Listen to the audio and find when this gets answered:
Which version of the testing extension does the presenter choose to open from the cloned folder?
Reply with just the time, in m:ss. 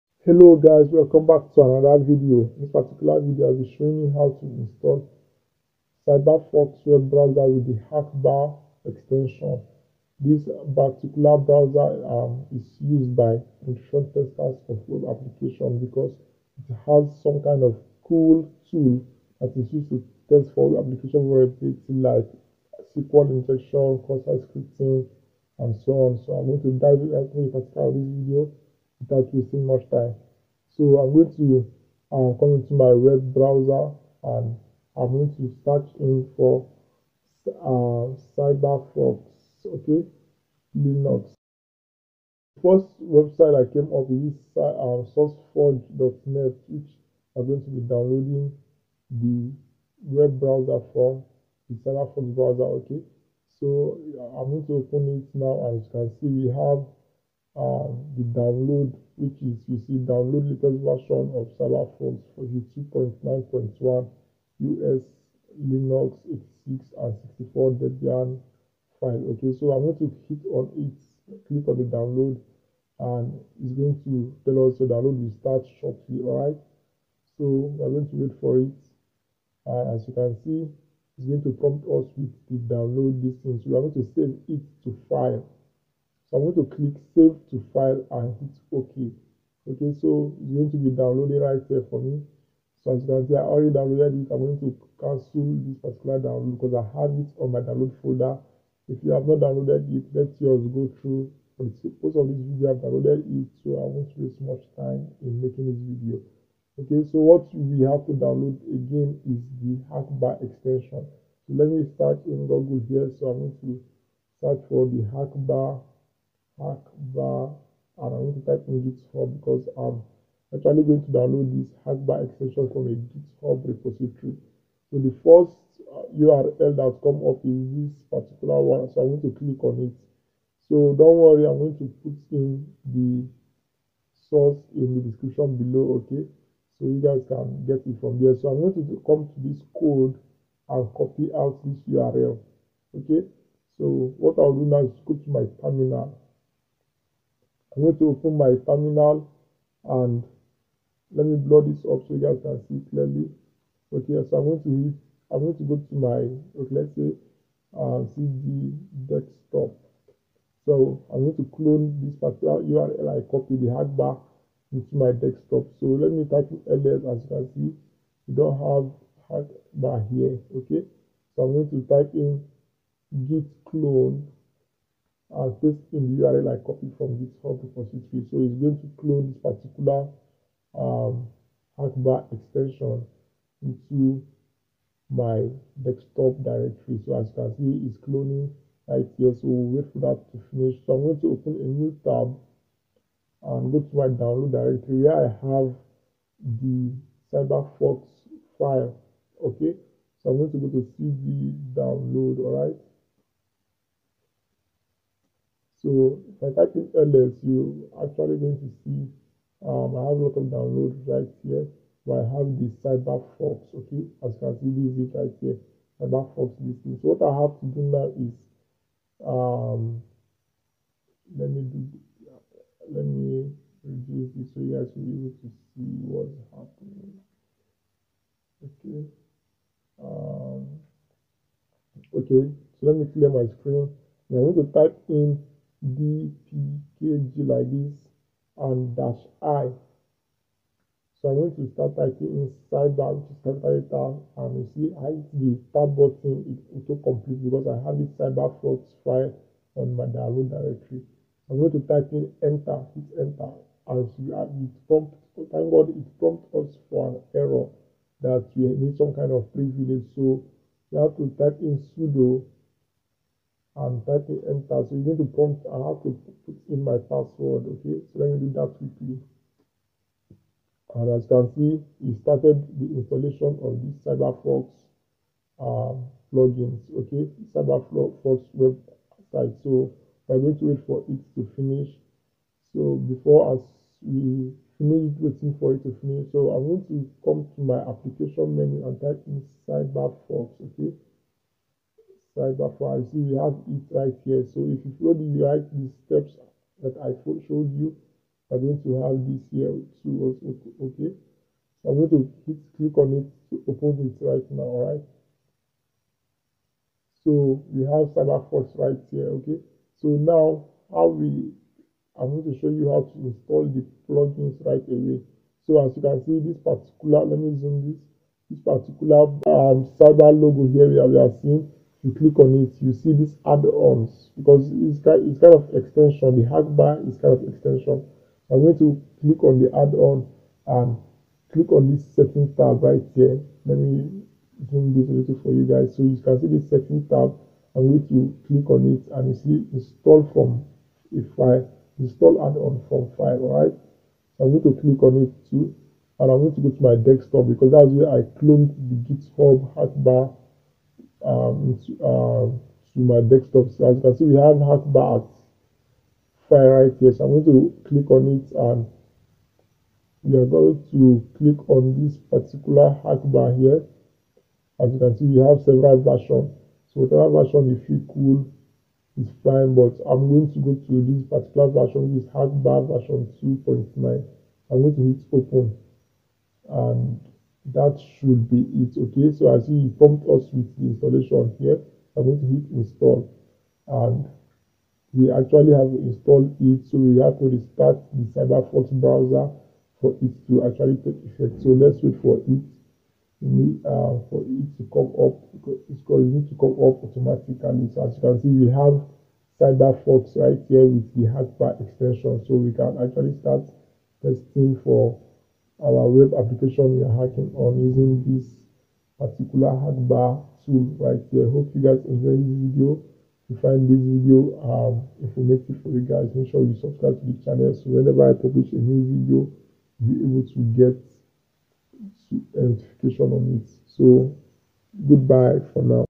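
6:13.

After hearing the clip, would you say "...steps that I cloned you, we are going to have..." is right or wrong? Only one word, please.
wrong.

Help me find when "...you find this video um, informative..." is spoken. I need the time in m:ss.
6:53.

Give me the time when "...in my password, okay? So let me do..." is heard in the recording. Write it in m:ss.
4:26.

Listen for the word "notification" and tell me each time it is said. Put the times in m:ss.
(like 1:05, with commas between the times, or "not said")
7:02.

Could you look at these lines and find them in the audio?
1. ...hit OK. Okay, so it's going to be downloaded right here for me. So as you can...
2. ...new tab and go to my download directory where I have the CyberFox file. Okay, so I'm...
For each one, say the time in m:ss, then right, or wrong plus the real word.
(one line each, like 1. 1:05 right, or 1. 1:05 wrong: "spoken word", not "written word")
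1. 1:28 right
2. 3:11 right.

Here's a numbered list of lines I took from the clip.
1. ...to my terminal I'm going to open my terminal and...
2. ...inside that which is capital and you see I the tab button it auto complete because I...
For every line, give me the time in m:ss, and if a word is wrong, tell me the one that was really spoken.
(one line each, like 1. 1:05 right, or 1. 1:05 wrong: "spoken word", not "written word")
1. 2:25 right
2. 4:02 right.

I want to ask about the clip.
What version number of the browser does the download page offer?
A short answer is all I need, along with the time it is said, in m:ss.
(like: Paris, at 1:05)
2.9.1, at 1:02.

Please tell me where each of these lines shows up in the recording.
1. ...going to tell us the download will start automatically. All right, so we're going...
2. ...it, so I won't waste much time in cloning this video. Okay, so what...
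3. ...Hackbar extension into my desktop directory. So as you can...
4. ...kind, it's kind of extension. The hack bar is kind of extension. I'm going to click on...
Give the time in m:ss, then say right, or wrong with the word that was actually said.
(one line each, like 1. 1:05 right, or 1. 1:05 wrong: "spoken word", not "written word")
1. 1:13 wrong: "shortly", not "automatically"
2. 1:43 wrong: "making", not "cloning"
3. 3:01 right
4. 5:25 right.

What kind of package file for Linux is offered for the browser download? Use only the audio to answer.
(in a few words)
Debian file.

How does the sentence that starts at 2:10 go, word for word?
So don't worry, I'm going to put in the source in the description below, okay?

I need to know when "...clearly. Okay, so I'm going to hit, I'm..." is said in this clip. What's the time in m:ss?
2:32.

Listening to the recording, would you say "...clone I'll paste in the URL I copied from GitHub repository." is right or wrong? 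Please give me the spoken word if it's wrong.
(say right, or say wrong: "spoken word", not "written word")
right.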